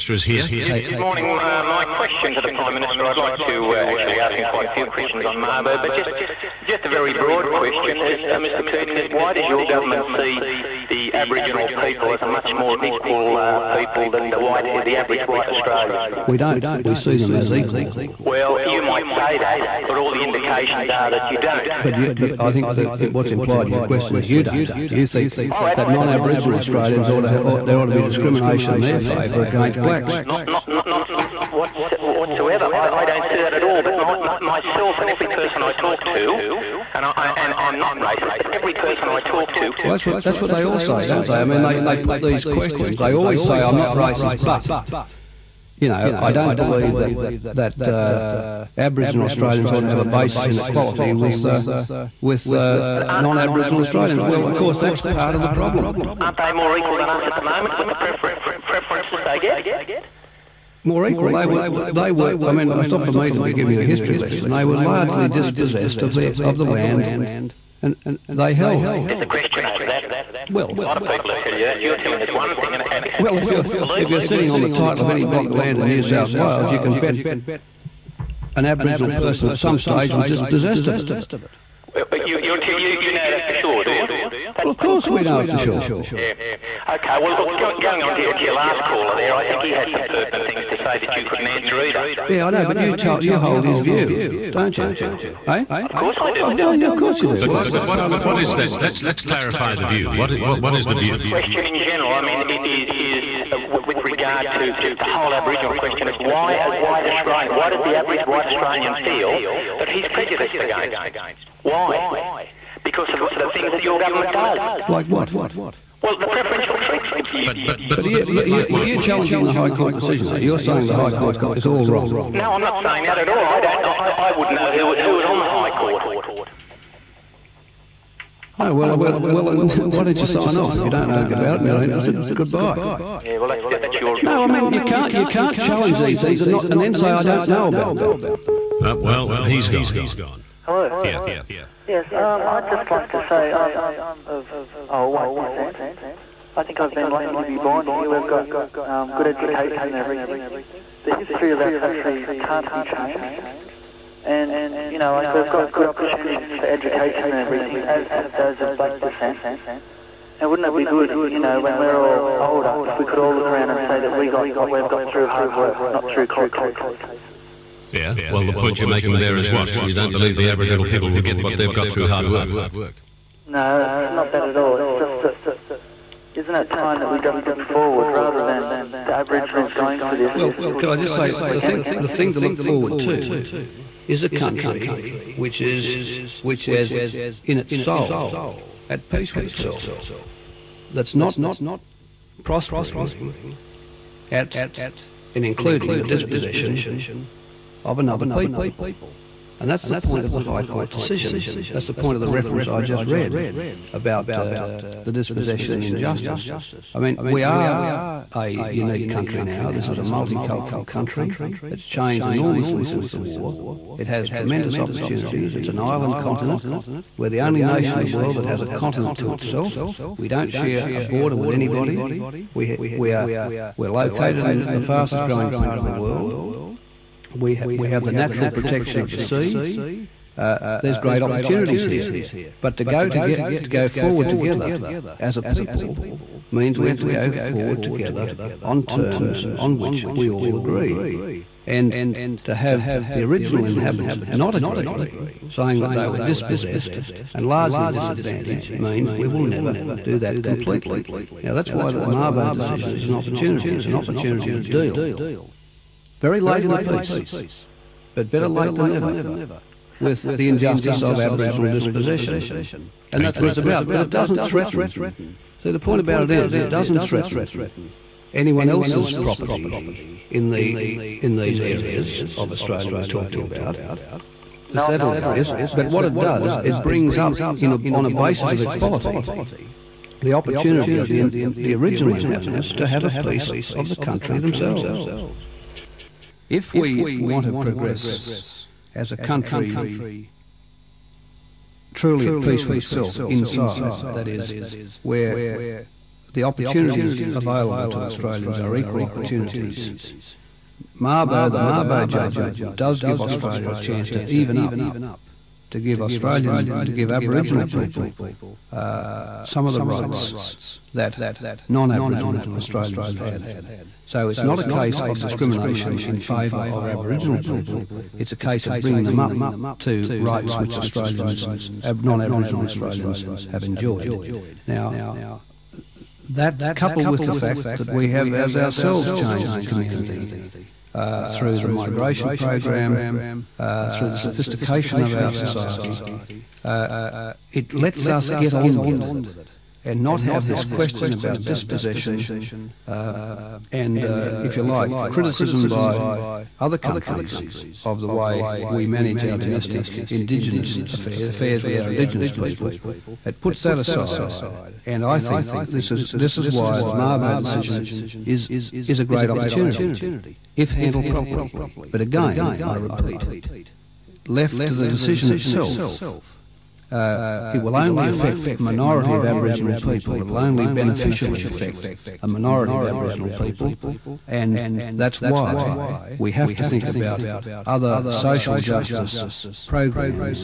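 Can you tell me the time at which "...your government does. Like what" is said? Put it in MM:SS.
01:53.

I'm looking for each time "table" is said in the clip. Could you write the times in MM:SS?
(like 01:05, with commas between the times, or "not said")
not said.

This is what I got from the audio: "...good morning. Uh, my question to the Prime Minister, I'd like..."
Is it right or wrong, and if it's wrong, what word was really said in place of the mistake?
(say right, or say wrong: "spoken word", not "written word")
right.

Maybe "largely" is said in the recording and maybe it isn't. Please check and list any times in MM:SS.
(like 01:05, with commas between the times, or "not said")
01:04, 04:07.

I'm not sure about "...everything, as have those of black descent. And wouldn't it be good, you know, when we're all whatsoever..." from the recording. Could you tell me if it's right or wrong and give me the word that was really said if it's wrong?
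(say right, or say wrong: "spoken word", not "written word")
wrong: "older", not "whatsoever".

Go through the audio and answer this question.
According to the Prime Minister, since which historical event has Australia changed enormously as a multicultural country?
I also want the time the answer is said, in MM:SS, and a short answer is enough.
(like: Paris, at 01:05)
The war, at 03:33.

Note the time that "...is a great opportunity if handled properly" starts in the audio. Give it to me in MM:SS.
05:58.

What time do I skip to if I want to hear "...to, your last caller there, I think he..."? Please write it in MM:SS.
01:28.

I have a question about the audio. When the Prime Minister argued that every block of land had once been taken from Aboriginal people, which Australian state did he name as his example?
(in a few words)
New South Wales.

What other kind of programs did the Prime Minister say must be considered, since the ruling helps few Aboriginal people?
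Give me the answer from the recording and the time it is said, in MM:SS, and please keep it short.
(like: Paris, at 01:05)
Social justice programs, at 06:18.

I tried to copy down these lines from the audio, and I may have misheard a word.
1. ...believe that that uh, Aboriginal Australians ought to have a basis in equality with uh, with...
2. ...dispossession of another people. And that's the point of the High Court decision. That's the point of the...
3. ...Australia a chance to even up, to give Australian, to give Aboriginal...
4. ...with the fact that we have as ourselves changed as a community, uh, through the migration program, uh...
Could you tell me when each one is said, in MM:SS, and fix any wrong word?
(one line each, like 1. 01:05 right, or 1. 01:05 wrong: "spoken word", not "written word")
1. 00:46 right
2. 03:16 right
3. 05:03 right
4. 05:27 right.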